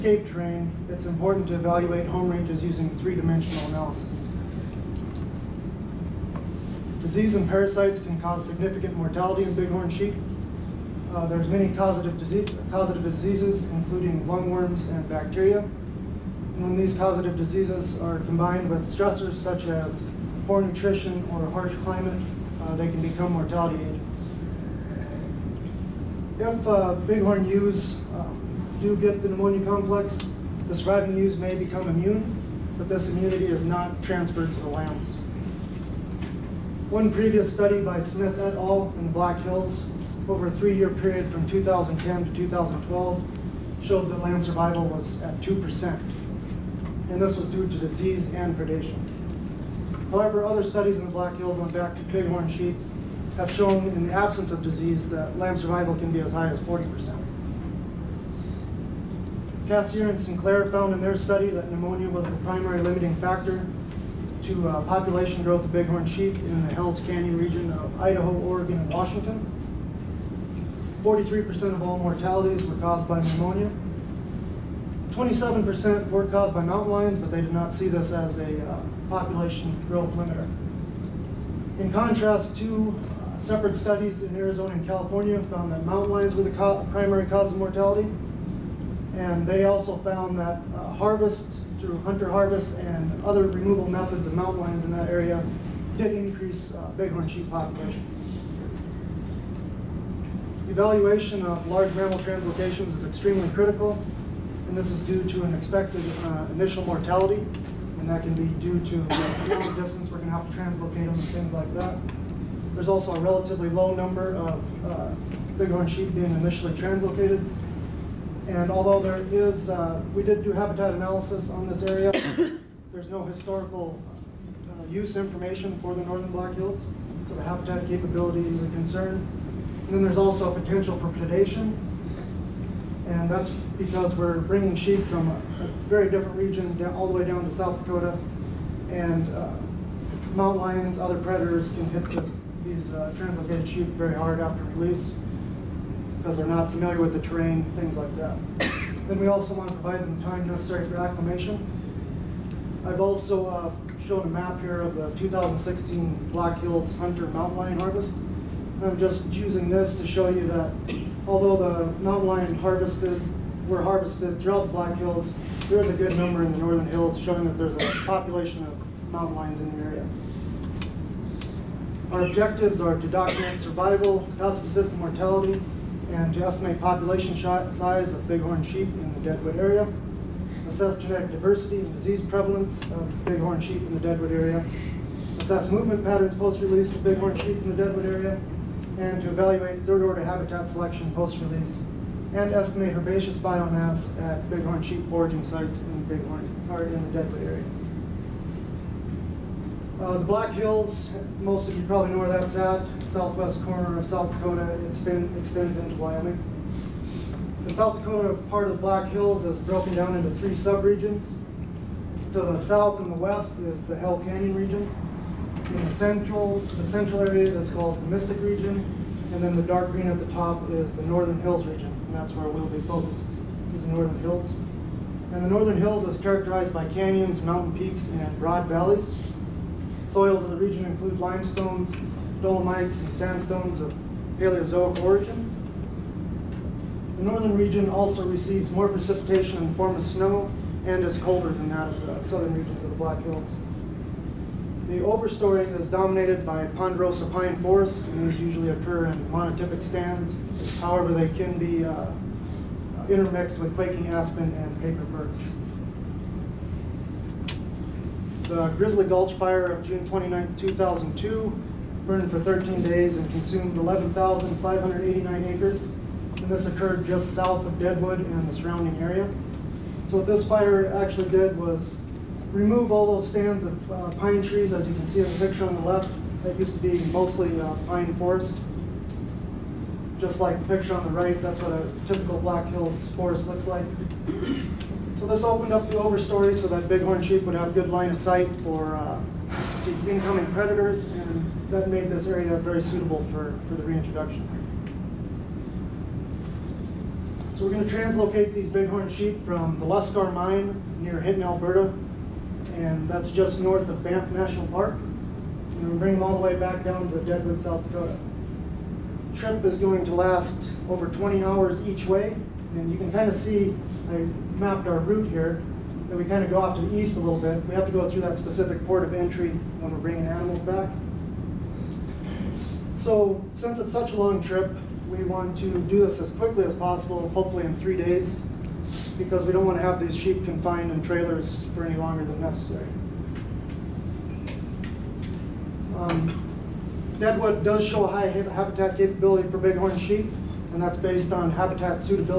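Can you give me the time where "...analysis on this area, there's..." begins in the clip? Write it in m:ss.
2:00.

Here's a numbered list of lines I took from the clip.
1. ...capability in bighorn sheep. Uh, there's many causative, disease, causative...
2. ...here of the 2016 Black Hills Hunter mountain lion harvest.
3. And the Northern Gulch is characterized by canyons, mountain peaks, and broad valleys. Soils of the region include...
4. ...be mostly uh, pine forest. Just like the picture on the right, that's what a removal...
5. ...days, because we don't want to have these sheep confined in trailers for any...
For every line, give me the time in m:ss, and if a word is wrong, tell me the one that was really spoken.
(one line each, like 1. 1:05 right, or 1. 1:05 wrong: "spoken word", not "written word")
1. 0:08 wrong: "mortality", not "capability"
2. 2:34 right
3. 3:45 wrong: "Hills", not "Gulch"
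4. 4:36 wrong: "typical", not "removal"
5. 5:27 right.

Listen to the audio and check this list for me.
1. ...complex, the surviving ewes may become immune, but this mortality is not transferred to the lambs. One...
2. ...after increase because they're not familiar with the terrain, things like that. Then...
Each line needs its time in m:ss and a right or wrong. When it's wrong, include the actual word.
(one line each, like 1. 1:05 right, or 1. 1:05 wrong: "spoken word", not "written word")
1. 0:29 wrong: "immunity", not "mortality"
2. 2:24 wrong: "release", not "increase".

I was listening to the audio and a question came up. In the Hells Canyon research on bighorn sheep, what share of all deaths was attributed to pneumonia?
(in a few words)
43%.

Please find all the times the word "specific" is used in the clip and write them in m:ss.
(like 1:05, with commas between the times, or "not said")
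2:54, 5:18.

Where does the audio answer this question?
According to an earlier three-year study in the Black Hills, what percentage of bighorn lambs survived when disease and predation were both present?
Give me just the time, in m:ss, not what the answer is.
0:45.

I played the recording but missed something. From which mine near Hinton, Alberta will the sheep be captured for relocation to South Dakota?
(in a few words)
Luscar mine.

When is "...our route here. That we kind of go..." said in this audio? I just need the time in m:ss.
5:14.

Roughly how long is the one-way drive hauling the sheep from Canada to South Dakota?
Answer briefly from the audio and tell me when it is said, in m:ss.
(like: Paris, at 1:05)
over 20 hours, at 5:10.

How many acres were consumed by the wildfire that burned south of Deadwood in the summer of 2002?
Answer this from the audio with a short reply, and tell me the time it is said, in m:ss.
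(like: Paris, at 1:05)
11,589 acres, at 4:23.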